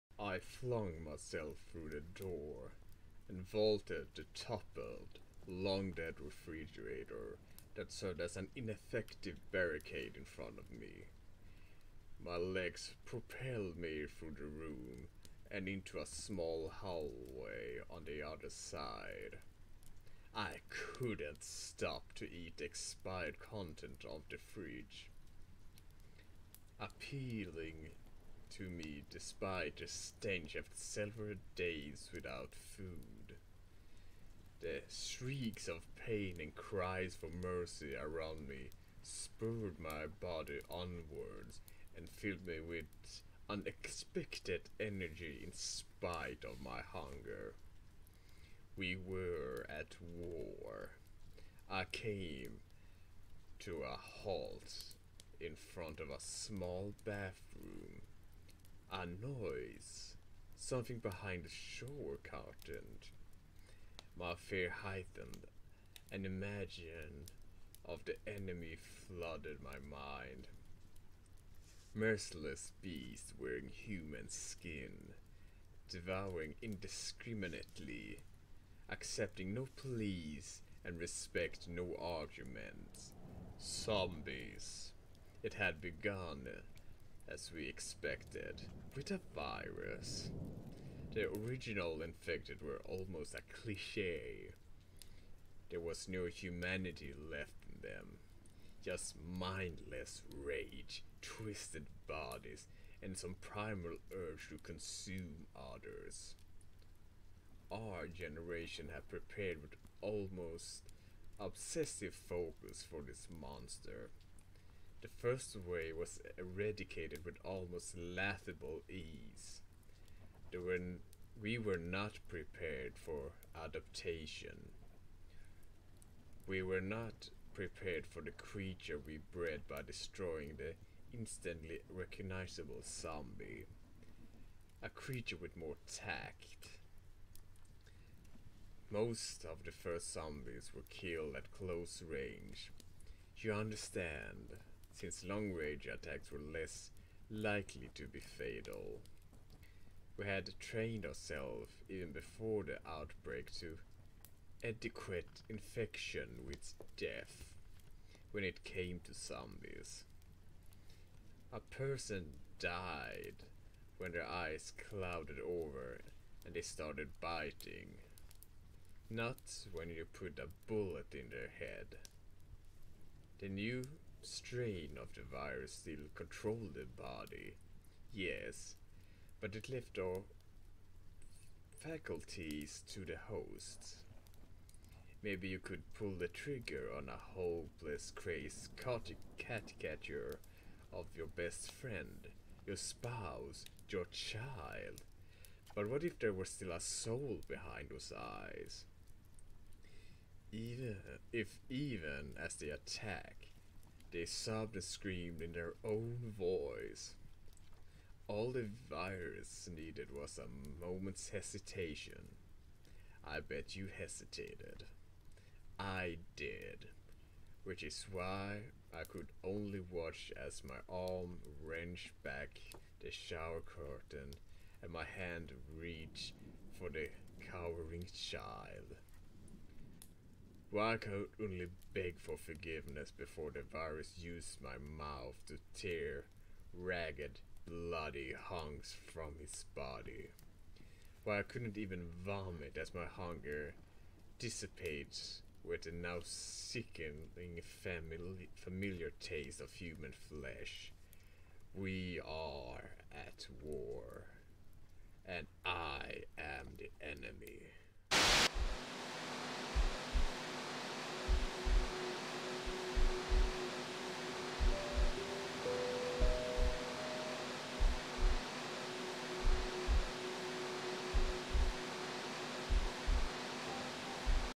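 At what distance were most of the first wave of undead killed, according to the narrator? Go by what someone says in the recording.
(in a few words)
close range.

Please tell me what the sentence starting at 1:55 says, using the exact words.
The first way was eradicated with almost laughable ease.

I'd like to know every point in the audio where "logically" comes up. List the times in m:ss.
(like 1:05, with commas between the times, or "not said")
not said.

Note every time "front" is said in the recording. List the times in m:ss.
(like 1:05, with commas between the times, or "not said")
0:10, 0:55.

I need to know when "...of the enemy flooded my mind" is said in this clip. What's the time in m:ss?
1:07.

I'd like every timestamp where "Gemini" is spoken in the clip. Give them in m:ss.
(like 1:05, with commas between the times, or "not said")
not said.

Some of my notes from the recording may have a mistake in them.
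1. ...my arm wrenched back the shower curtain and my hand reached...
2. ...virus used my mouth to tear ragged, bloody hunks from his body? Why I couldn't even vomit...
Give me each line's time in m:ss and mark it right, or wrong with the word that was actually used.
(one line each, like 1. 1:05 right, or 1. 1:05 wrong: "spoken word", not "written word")
1. 3:40 right
2. 3:53 right.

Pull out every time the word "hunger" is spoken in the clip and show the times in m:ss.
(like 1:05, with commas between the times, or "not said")
0:46, 4:03.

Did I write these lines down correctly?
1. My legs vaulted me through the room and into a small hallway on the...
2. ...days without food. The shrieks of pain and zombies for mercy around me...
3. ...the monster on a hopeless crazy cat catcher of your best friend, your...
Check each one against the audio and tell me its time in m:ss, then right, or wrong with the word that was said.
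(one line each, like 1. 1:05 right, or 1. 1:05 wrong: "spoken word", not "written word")
1. 0:12 wrong: "propelled", not "vaulted"
2. 0:31 wrong: "cries", not "zombies"
3. 3:06 wrong: "trigger", not "monster".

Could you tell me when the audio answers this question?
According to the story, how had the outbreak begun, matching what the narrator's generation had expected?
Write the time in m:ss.
1:28.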